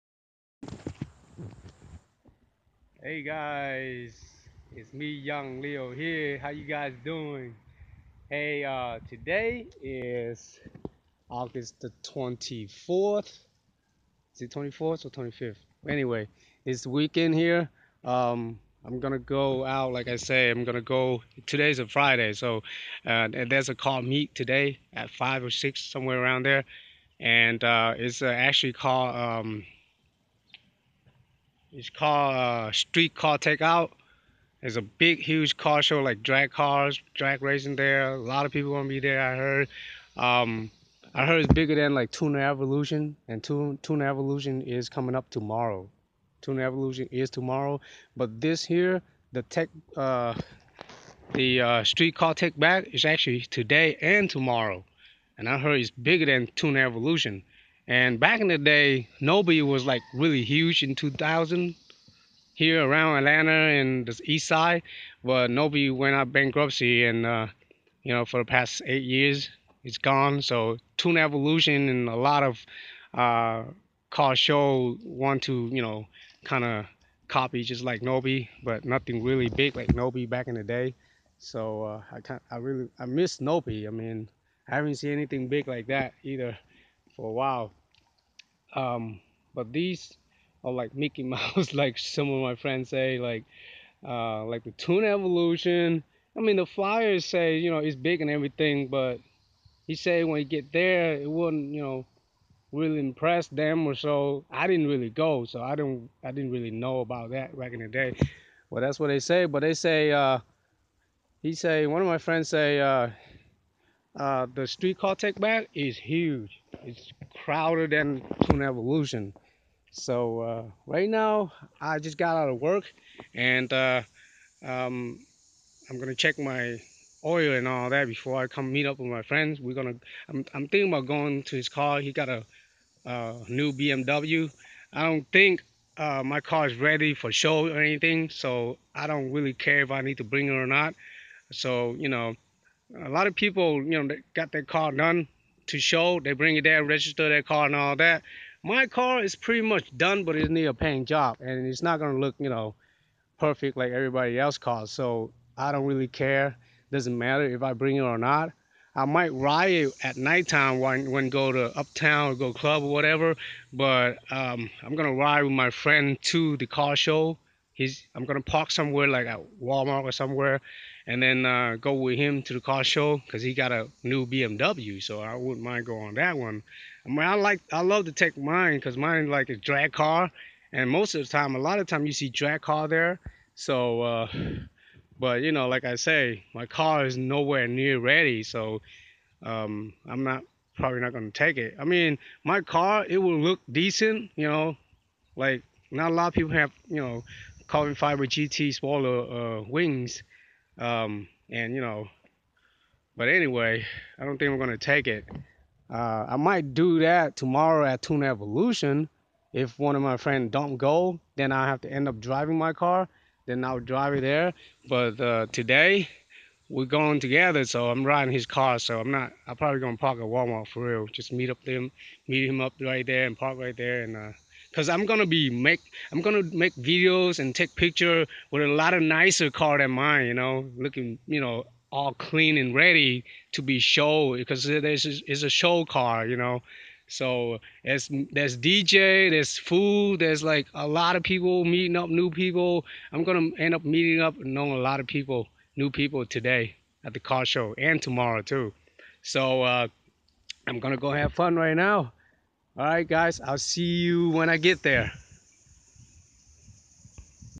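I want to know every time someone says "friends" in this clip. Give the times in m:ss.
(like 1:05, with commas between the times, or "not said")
1:32, 1:52, 2:09, 2:45, 3:30.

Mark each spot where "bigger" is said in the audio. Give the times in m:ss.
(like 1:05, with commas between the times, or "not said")
0:41, 0:55.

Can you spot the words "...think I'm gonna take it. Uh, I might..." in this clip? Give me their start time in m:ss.
3:24.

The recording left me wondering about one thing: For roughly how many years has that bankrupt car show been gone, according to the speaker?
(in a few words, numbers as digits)
8.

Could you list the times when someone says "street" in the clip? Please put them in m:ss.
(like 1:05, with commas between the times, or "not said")
0:32, 0:51, 1:54.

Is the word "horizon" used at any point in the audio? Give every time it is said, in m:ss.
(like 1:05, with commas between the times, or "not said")
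not said.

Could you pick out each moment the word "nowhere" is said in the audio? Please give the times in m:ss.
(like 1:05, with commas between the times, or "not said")
3:07.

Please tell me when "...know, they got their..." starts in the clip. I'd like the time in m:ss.
2:24.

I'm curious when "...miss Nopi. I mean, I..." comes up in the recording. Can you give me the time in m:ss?
1:23.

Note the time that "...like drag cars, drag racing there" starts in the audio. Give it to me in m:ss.
0:36.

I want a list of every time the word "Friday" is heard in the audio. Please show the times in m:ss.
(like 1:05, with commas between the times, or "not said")
0:21.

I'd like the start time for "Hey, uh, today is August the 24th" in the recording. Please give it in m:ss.
0:08.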